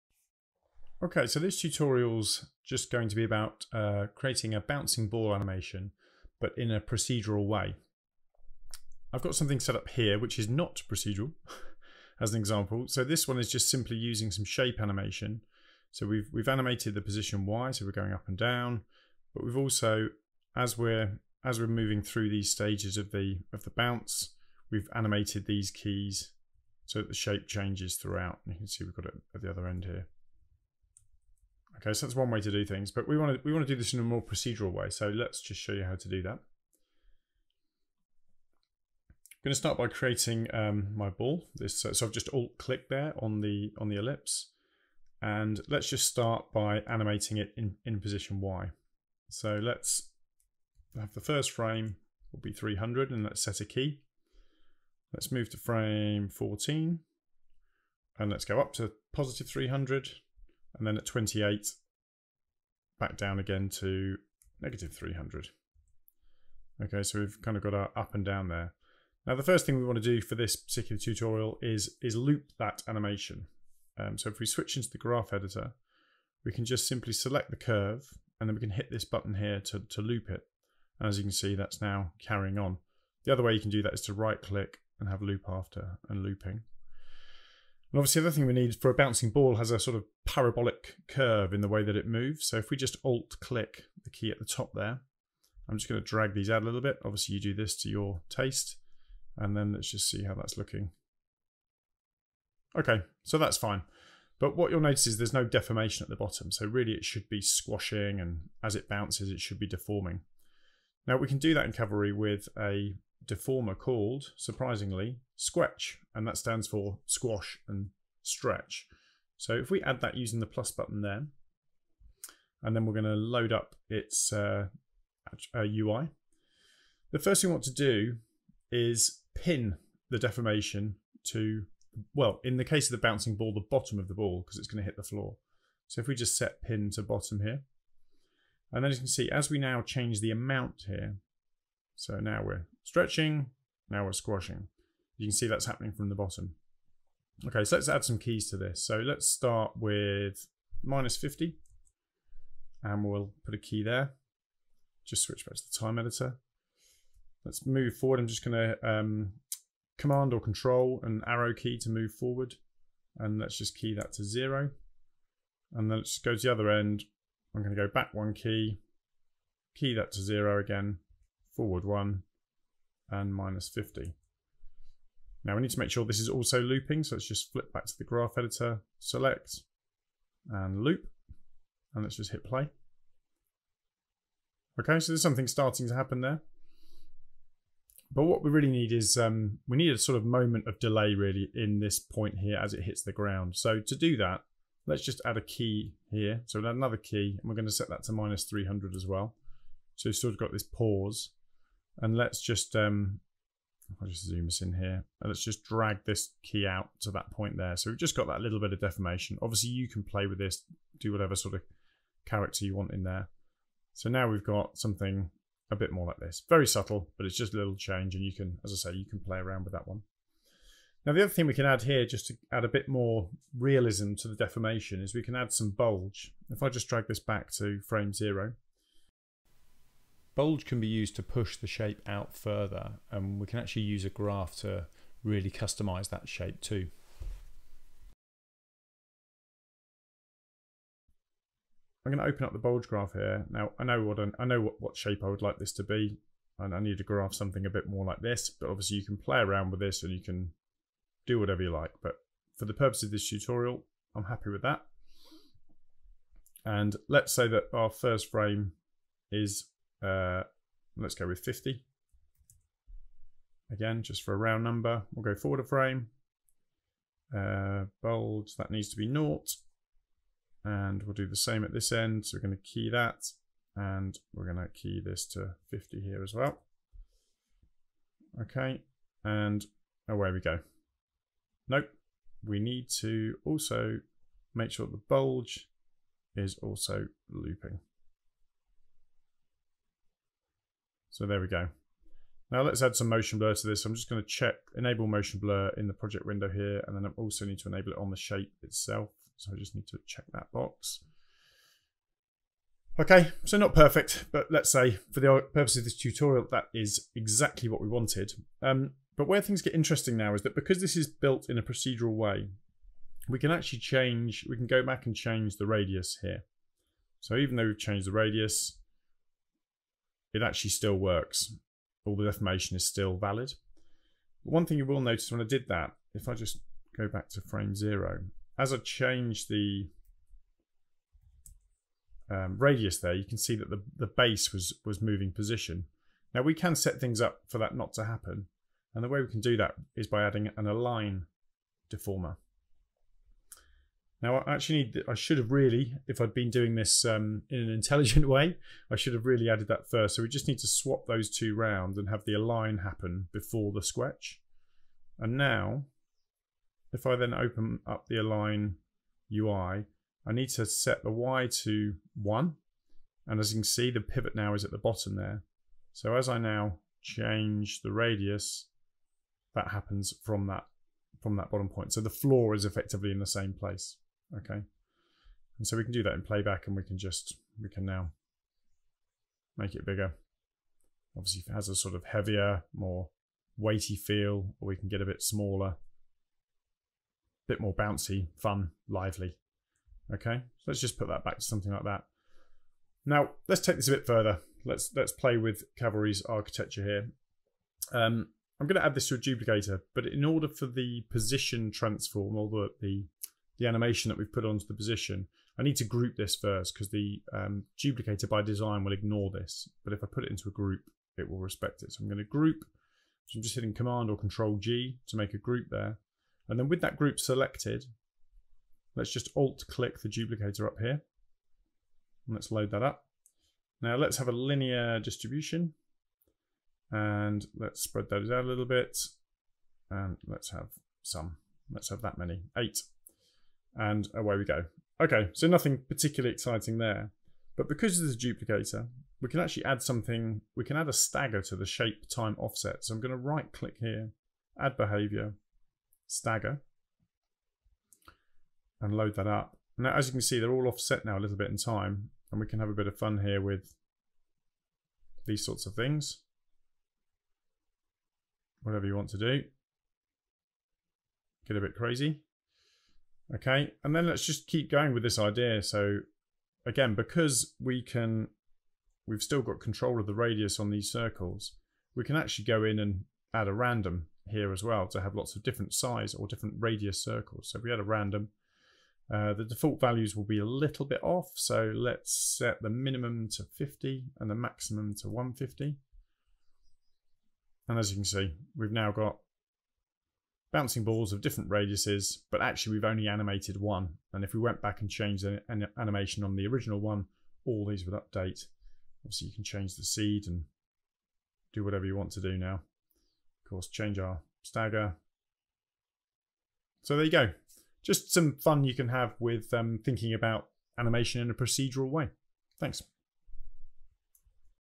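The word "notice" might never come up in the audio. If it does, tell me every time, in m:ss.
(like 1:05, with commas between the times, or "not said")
1:44, 5:25.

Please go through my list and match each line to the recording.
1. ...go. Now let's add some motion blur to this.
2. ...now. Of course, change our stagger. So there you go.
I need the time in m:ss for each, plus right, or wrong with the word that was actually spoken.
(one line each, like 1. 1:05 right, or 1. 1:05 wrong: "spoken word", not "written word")
1. 4:51 right
2. 8:22 right.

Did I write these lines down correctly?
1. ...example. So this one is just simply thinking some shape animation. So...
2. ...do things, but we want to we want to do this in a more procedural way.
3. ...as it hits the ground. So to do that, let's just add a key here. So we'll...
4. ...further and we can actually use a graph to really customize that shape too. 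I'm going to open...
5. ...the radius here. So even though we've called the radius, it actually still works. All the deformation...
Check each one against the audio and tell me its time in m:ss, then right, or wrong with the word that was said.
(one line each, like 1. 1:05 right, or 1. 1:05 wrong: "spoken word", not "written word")
1. 0:12 wrong: "using", not "thinking"
2. 0:32 right
3. 3:12 right
4. 3:52 right
5. 5:15 wrong: "changed", not "called".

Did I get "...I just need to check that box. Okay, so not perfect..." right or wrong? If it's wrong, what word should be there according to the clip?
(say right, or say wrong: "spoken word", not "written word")
right.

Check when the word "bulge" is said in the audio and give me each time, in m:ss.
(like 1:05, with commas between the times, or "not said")
3:45, 3:50, 4:02, 4:45.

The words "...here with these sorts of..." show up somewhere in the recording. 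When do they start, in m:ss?
7:33.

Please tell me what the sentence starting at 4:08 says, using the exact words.
But obviously you can play around with this and you can do whatever you like.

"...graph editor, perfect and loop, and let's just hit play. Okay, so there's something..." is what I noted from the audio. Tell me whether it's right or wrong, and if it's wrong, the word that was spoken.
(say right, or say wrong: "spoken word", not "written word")
wrong: "select", not "perfect".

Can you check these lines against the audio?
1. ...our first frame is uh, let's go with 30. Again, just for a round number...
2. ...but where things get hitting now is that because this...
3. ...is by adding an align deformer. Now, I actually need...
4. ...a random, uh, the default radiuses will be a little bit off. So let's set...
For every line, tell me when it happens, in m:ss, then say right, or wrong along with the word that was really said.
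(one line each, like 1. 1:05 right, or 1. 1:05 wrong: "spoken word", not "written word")
1. 4:17 wrong: "50", not "30"
2. 5:09 wrong: "interesting", not "hitting"
3. 5:39 right
4. 7:57 wrong: "values", not "radiuses".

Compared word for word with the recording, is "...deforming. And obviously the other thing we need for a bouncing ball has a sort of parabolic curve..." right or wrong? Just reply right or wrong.
wrong.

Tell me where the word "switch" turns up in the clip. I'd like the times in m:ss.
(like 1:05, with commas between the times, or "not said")
1:14, 2:35.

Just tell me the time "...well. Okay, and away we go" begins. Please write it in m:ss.
4:36.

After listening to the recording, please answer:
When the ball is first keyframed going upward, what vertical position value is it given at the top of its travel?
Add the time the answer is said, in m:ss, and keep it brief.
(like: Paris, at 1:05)
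300, at 0:59.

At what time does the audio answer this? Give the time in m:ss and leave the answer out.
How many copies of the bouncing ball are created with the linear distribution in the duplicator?
7:12.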